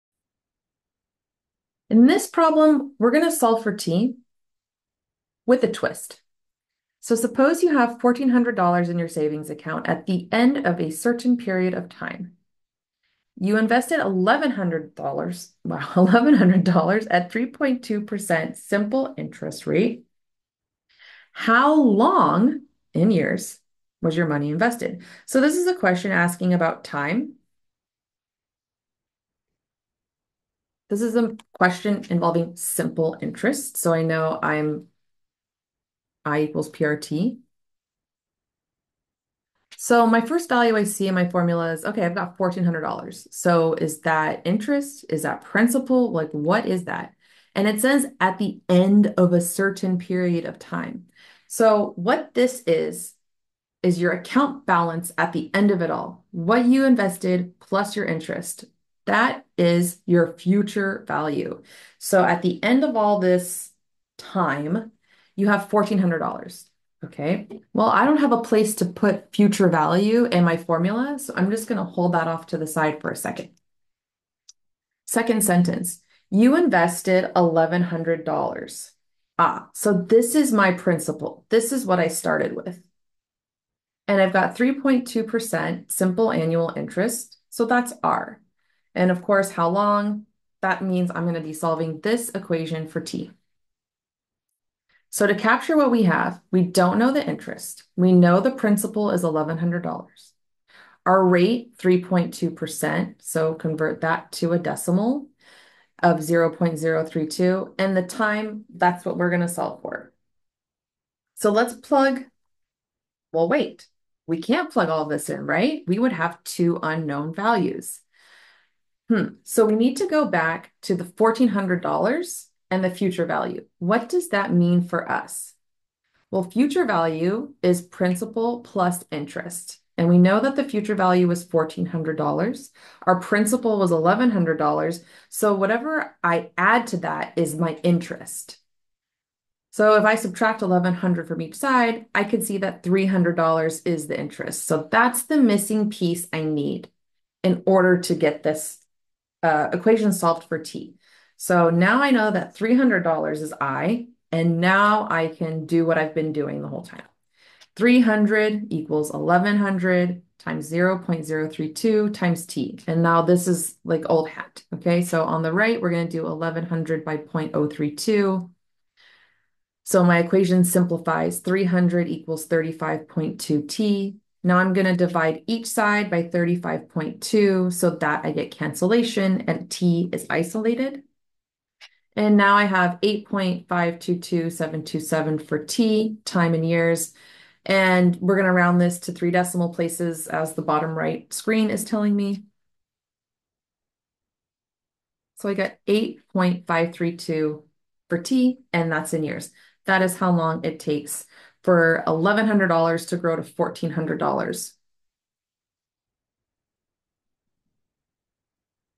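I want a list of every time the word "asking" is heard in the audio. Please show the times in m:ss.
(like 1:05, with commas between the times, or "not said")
0:26.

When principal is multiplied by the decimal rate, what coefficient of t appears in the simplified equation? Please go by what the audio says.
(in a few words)
35.2.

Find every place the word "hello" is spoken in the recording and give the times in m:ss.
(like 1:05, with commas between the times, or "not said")
not said.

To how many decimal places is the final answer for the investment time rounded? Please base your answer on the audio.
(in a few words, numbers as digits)
3.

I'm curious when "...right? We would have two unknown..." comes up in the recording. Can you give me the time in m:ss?
1:55.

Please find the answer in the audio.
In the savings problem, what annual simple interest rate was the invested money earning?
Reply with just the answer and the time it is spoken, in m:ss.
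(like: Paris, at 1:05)
3.2%, at 0:17.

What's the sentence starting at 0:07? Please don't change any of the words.
So suppose you have $1,400 in your savings account at the end of a certain period of time.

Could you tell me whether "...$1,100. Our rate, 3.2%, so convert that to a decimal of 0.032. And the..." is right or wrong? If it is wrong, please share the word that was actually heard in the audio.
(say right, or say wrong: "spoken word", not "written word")
right.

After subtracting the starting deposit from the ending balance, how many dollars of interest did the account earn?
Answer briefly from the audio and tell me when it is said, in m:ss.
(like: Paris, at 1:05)
$300, at 2:22.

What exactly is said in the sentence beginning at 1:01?
So at the end of all this time, you have $1,400.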